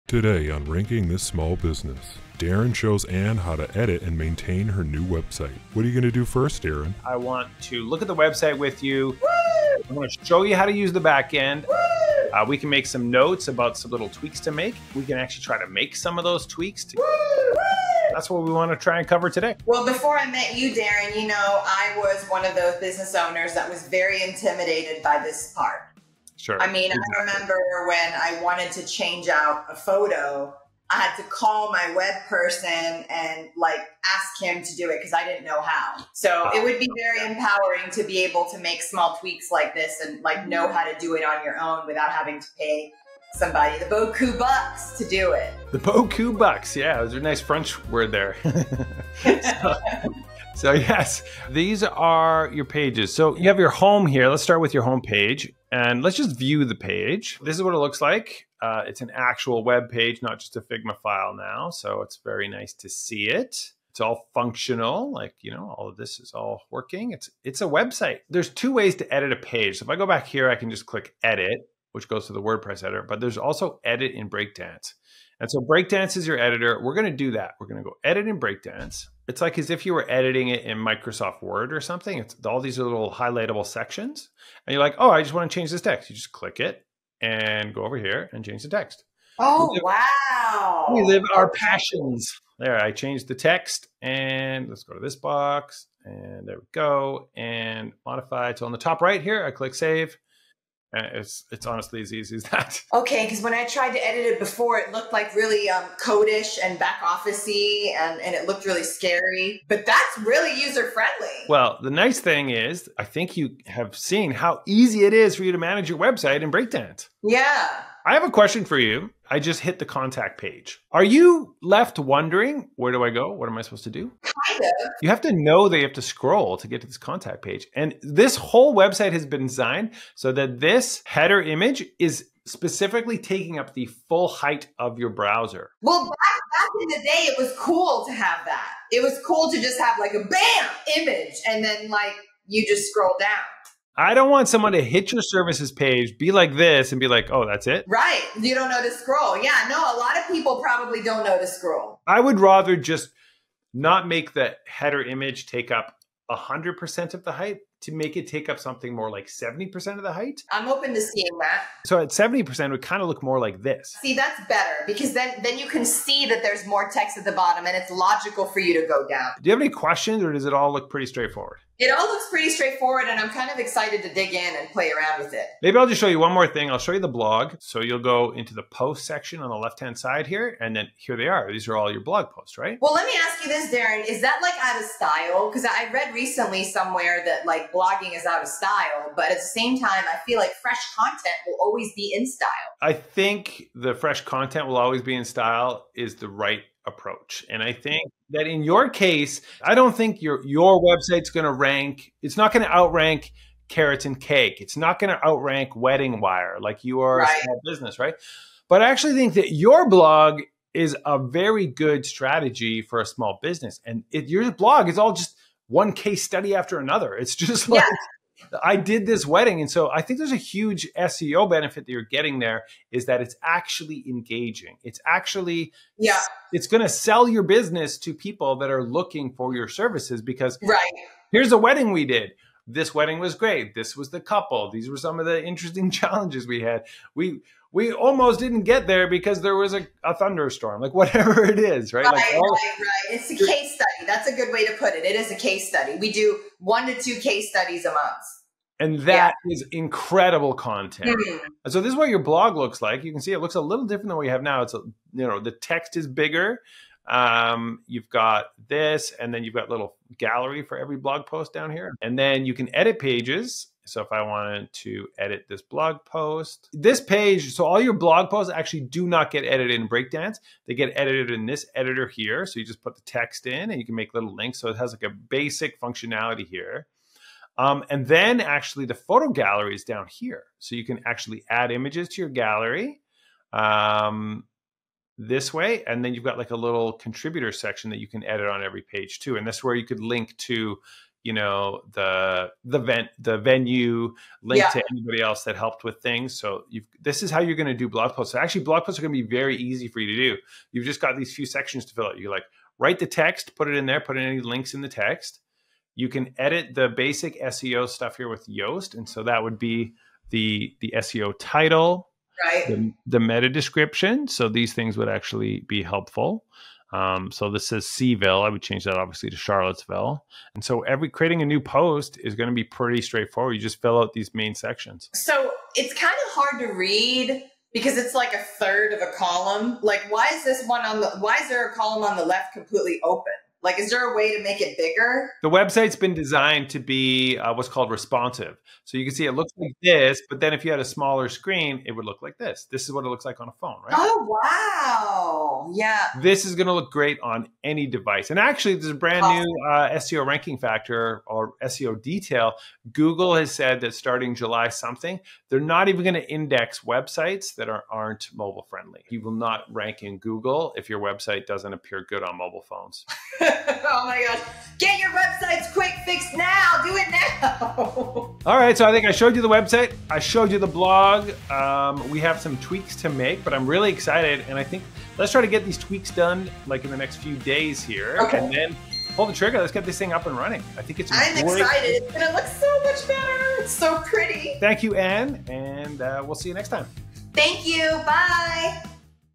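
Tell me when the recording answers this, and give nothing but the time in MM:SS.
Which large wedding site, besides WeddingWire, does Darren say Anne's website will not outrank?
03:23.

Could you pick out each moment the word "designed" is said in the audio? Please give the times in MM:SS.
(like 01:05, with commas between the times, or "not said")
02:09, 05:36.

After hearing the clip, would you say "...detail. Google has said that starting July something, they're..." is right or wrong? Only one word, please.
right.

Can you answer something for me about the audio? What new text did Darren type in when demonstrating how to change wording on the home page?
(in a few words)
We live our passions.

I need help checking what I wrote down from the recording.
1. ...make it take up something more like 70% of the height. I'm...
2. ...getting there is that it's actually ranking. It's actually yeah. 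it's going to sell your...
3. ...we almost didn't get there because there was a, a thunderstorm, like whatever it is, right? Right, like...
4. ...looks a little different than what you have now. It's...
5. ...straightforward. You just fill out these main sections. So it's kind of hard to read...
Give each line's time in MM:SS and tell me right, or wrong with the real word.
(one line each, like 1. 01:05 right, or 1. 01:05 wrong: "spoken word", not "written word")
1. 02:37 right
2. 03:42 wrong: "engaging", not "ranking"
3. 03:57 right
4. 04:13 right
5. 05:23 right.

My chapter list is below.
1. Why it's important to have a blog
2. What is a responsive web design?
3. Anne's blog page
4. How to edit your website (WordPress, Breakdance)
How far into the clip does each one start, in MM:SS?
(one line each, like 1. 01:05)
1. 02:55
2. 05:25
3. 04:11
4. 00:51.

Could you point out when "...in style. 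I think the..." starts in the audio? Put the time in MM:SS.
03:12.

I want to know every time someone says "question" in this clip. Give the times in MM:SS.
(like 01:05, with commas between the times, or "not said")
01:58, 02:49.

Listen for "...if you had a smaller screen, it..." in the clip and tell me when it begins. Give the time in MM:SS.
05:40.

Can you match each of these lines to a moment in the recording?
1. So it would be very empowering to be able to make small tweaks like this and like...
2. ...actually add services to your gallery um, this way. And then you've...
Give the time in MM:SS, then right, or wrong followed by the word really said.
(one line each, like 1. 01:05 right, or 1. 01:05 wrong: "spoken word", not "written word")
1. 00:36 right
2. 04:41 wrong: "images", not "services".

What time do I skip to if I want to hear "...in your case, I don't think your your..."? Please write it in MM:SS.
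03:18.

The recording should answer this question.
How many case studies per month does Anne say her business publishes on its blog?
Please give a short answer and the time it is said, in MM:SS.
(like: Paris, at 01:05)
1 to 2, at 04:06.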